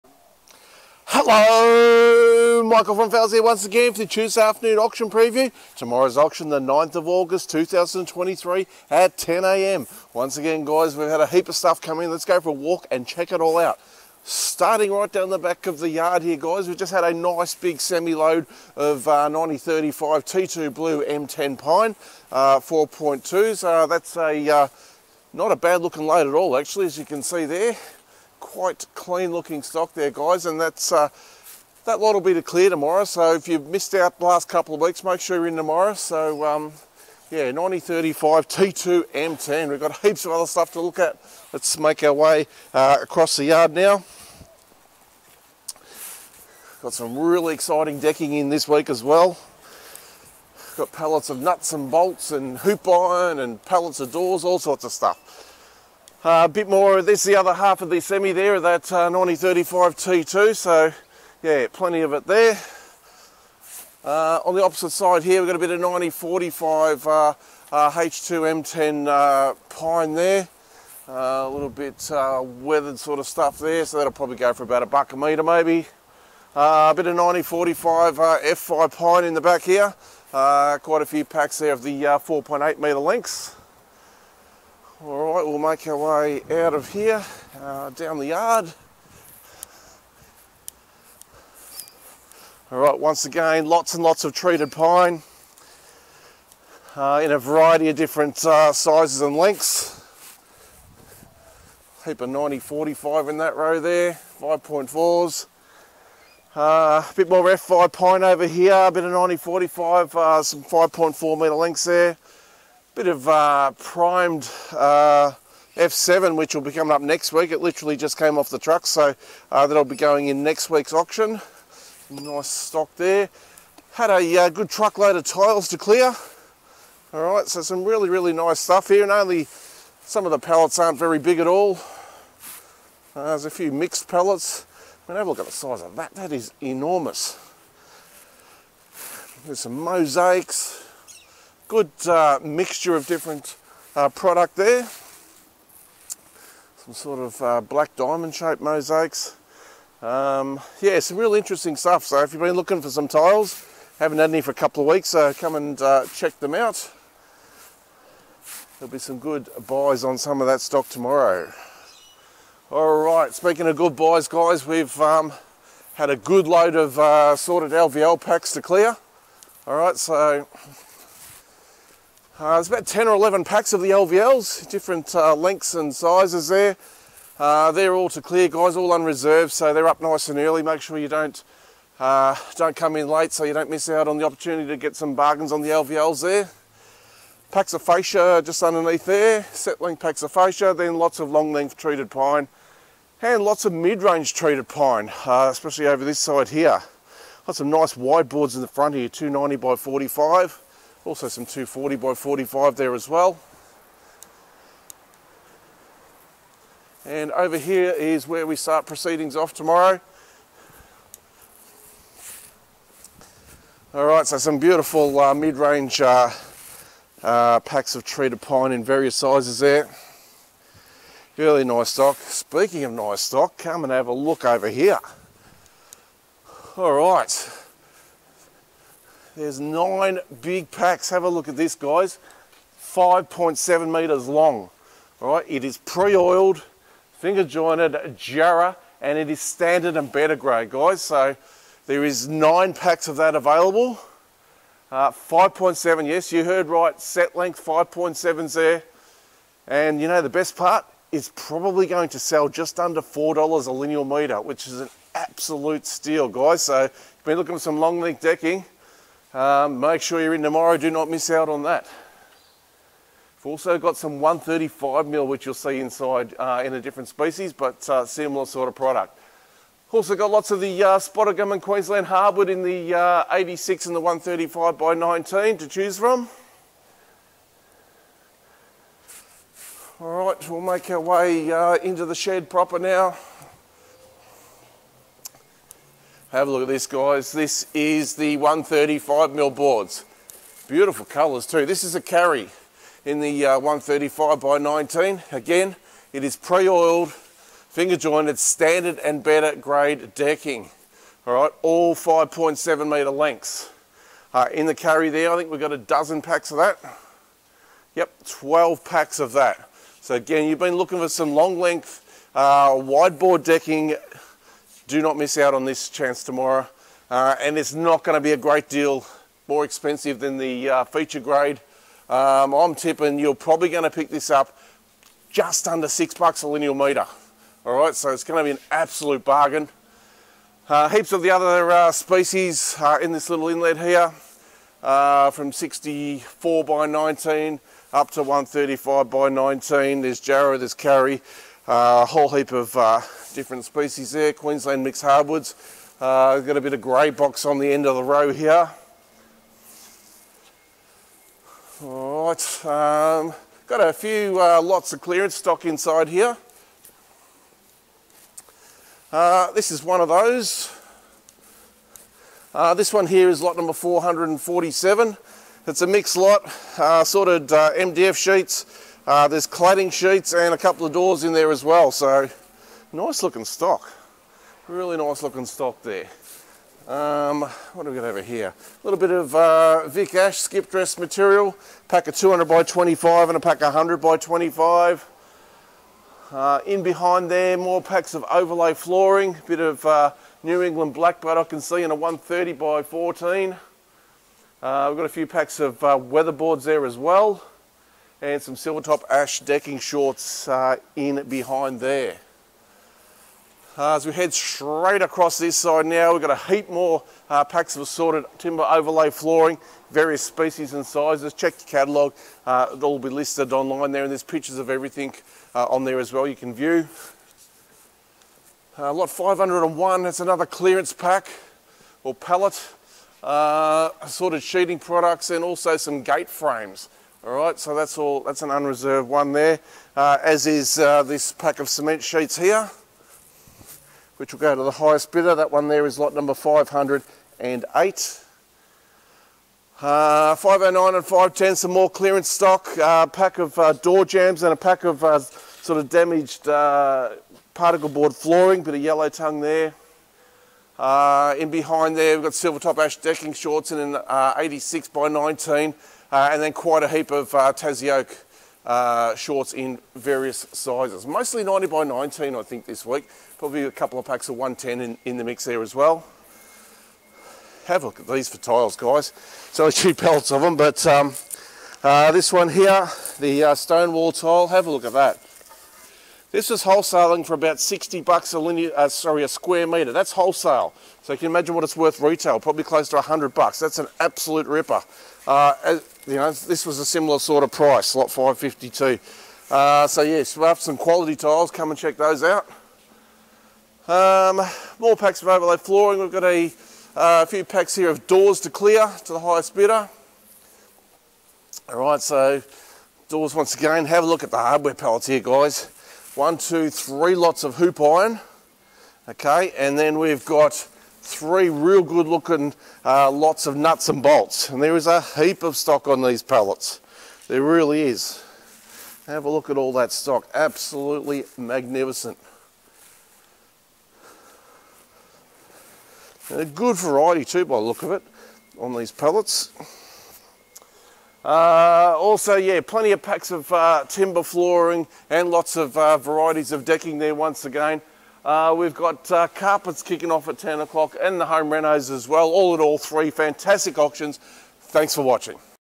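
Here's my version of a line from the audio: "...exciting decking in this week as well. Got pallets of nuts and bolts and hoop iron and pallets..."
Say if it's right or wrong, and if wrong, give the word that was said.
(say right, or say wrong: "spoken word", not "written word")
right.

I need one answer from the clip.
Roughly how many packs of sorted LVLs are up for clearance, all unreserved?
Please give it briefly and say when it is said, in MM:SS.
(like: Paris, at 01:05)
10 or 11, at 02:52.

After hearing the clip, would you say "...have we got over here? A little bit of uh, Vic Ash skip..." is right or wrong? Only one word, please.
right.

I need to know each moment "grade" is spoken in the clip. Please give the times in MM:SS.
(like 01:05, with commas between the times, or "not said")
04:00, 04:59, 05:21.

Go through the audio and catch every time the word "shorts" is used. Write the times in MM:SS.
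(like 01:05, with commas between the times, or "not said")
06:39, 07:33, 07:39.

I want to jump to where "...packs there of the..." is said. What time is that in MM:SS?
01:21.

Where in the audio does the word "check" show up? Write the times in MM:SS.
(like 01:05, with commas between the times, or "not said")
00:13, 02:36, 06:51, 08:11.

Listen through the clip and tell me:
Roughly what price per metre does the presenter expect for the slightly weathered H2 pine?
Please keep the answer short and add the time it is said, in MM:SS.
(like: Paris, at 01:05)
About $1 a metre, at 01:14.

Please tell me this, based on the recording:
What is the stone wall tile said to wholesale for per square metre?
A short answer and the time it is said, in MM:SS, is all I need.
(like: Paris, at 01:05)
About $60, at 07:57.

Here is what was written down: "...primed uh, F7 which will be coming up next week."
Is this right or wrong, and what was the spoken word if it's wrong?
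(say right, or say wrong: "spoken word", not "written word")
right.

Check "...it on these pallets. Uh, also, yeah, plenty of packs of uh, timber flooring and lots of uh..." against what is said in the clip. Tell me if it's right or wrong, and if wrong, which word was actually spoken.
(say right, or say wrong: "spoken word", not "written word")
right.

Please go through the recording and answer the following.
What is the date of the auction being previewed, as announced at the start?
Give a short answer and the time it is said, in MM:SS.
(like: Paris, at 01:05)
9 August 2023, at 00:06.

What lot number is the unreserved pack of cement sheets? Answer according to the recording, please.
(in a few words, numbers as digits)
508.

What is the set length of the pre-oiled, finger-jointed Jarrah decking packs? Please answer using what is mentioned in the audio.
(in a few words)
5.7 metres.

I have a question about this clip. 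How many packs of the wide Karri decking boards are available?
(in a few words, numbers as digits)
12.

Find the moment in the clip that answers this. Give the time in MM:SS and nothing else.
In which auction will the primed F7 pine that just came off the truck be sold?
02:00.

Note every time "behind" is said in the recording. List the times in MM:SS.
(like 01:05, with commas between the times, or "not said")
06:26, 06:41, 07:31.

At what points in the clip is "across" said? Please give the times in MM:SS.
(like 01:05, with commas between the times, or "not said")
00:43, 06:45.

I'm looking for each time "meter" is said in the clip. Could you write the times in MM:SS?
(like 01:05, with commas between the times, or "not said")
03:53, 04:14, 07:59.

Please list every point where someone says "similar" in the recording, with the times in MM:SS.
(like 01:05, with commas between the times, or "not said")
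04:28, 08:06.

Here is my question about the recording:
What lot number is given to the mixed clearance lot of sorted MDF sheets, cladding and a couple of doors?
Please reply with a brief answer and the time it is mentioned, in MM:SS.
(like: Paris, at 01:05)
447, at 06:03.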